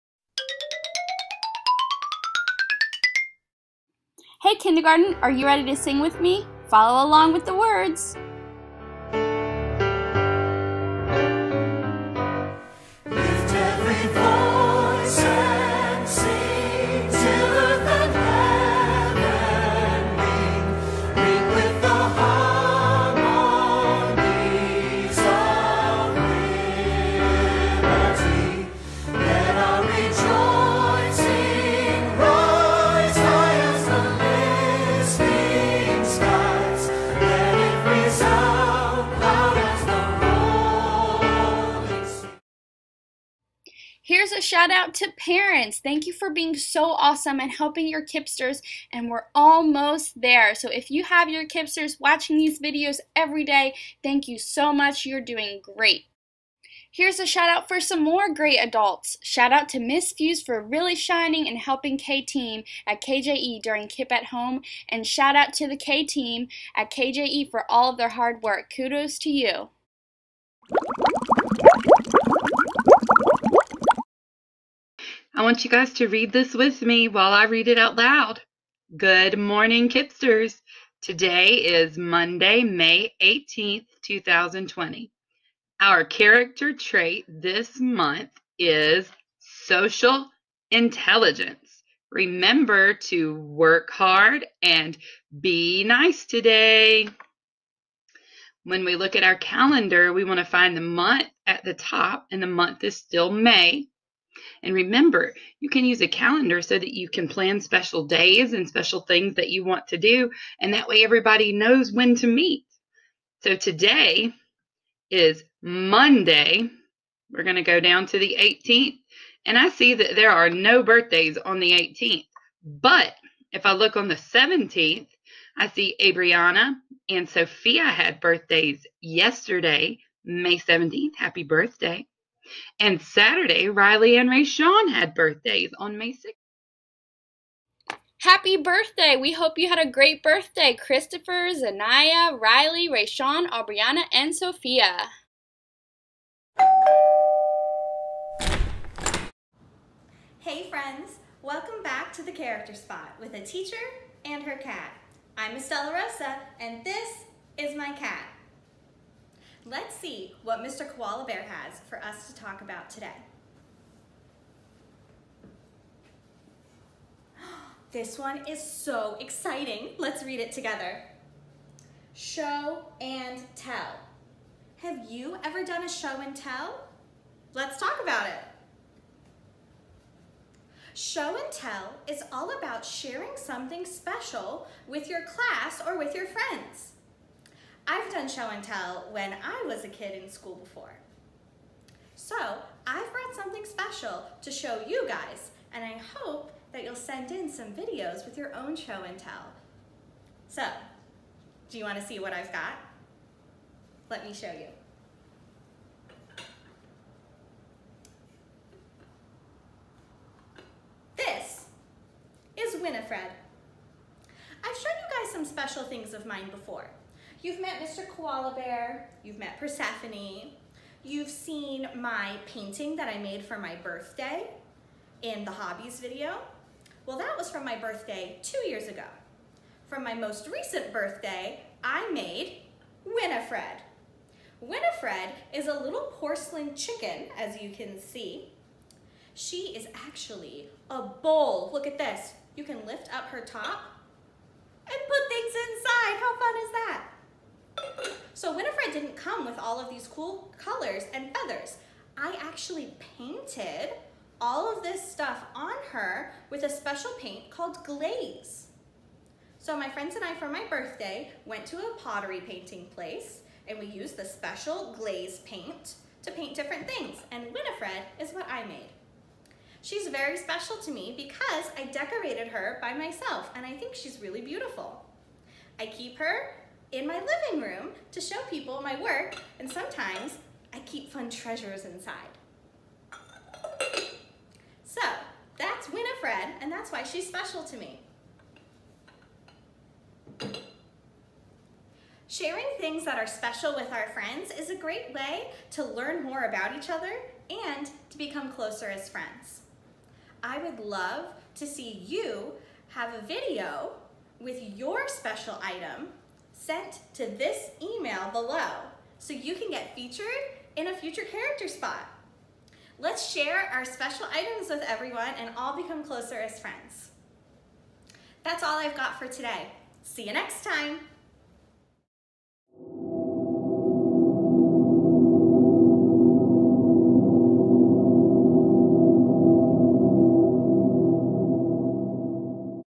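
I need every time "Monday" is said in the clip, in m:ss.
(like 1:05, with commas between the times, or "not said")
1:21, 1:55.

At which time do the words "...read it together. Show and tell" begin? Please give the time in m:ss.
2:50.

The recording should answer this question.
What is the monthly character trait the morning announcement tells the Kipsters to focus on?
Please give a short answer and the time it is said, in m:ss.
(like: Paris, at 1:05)
social intelligence, at 1:29.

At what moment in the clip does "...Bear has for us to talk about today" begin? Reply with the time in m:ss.
2:41.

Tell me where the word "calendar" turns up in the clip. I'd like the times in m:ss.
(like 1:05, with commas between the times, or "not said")
1:39, 1:46.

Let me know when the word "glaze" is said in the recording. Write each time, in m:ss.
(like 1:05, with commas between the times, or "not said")
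4:17, 4:24.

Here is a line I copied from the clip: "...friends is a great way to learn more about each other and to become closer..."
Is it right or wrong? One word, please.
right.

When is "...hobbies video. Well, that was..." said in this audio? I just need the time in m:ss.
3:45.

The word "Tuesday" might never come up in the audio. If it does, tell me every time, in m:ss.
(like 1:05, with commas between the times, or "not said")
not said.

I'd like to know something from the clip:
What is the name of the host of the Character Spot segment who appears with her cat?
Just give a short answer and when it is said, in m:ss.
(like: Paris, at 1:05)
Estella Rosa, at 2:35.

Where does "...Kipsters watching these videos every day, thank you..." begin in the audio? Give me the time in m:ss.
0:51.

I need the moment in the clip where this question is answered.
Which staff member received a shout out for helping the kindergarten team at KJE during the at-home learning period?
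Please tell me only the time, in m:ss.
0:59.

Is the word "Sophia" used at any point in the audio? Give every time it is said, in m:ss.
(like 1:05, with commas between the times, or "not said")
2:07, 2:24.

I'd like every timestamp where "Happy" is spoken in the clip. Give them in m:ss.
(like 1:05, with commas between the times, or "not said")
2:11, 2:18.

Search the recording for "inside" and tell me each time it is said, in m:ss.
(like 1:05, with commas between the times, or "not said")
4:05, 4:41.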